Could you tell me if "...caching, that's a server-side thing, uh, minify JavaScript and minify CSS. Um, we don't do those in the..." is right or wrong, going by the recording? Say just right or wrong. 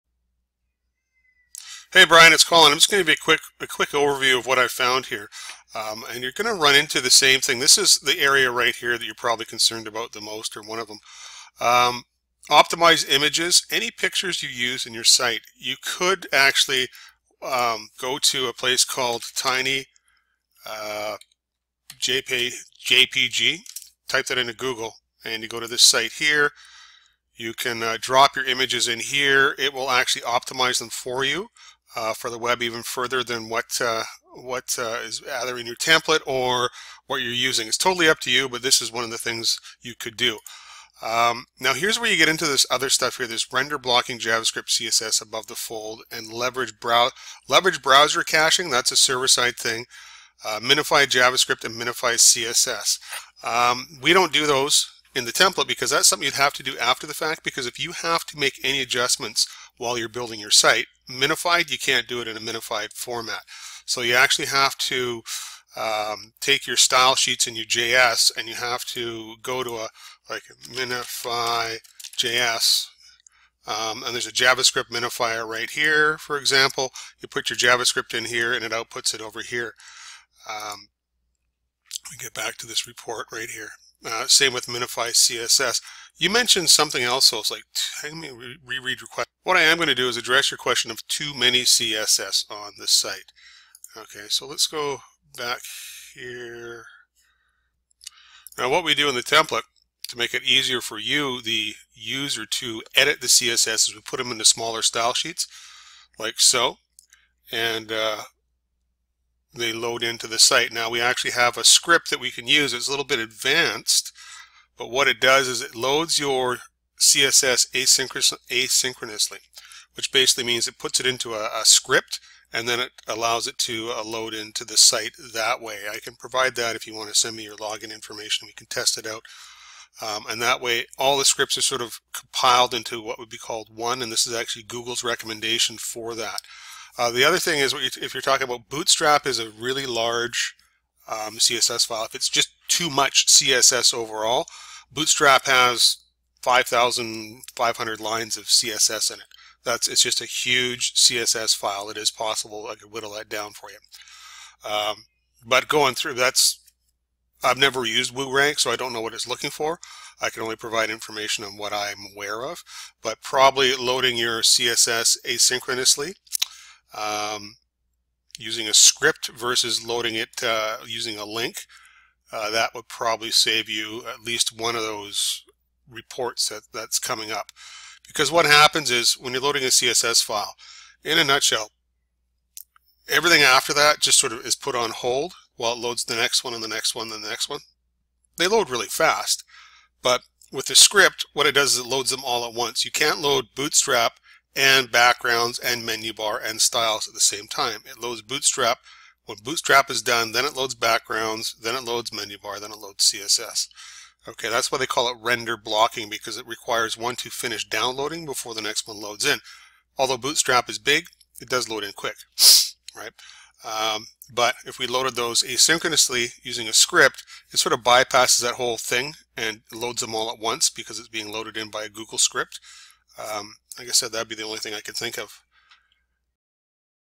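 right.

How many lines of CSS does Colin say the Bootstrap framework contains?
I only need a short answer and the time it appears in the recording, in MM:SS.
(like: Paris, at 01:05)
5,500, at 02:26.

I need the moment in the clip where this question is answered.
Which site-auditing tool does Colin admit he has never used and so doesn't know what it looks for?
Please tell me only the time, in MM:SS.
02:38.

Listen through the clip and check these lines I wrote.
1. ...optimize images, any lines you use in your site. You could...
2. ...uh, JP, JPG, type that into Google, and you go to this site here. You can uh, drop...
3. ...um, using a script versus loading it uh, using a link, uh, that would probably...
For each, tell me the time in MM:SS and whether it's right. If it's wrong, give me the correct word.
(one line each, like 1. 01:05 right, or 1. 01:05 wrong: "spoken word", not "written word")
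1. 00:12 wrong: "pictures", not "lines"
2. 00:20 right
3. 02:46 right.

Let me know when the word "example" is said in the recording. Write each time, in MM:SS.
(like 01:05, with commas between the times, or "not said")
01:16.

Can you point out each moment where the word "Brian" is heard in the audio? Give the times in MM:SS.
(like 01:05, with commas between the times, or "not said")
00:02.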